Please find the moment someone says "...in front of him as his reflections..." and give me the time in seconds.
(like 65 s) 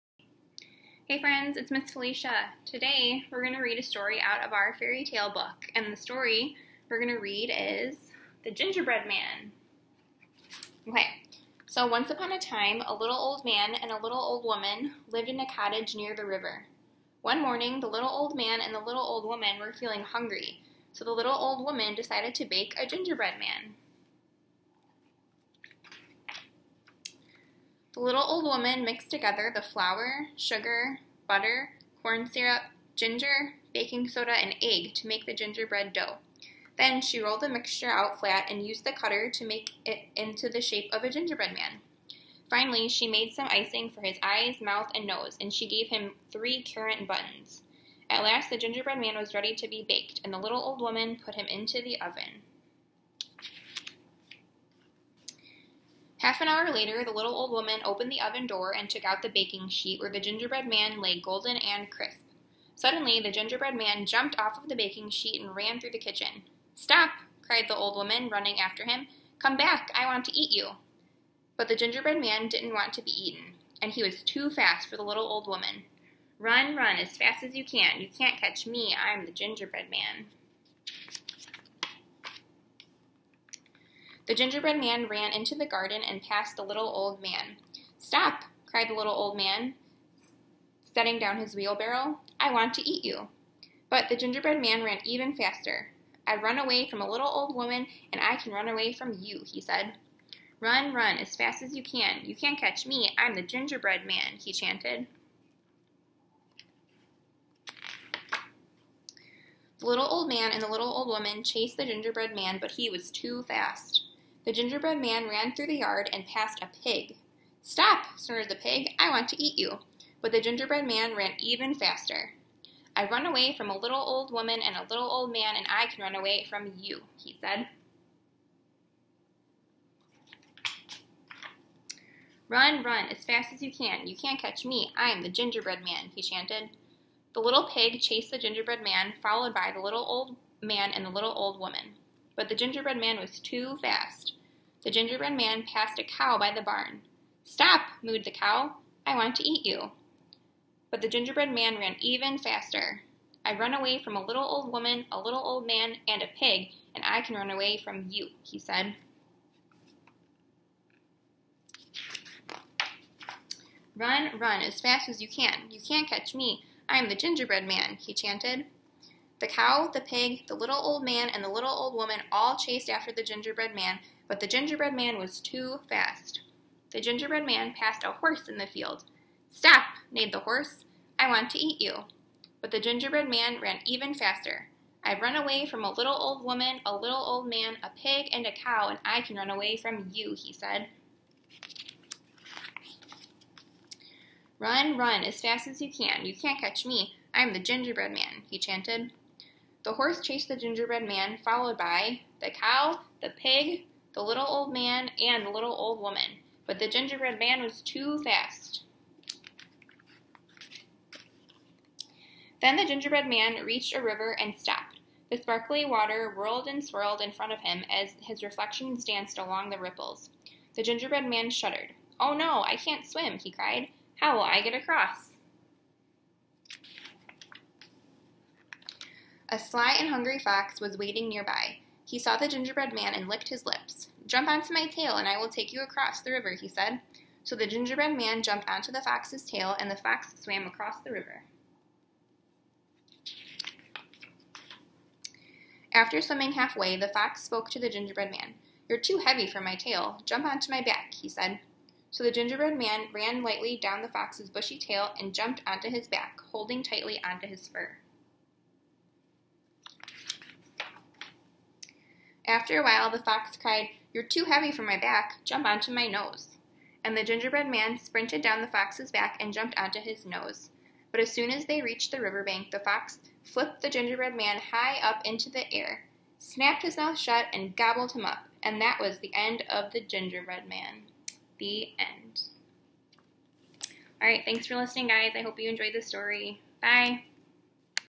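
217 s.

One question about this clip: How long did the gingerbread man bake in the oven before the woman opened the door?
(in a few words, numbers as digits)
Half an hour.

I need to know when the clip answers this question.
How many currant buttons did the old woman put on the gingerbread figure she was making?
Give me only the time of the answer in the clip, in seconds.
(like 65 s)
46 s.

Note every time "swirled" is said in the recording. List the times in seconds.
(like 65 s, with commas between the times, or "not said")
216 s.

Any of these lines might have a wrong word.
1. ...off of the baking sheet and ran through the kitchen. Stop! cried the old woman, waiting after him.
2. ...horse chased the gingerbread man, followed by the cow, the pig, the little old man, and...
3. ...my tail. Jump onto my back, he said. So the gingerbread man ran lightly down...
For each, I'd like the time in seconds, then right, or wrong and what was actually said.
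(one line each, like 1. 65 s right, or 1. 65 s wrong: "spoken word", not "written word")
1. 64 s wrong: "running", not "waiting"
2. 199 s right
3. 249 s right.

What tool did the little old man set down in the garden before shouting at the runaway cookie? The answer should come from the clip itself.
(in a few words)
wheelbarrow.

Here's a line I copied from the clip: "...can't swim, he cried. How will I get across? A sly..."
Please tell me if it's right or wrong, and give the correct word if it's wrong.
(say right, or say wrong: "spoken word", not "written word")
right.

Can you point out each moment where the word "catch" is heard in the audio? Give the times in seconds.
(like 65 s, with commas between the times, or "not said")
78 s, 102 s, 134 s, 166 s, 196 s.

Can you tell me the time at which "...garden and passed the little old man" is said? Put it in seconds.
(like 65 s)
85 s.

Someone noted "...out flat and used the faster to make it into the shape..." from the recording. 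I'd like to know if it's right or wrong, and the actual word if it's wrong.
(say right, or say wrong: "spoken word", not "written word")
wrong: "cutter", not "faster".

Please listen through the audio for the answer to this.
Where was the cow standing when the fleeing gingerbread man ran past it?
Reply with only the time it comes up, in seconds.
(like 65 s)
146 s.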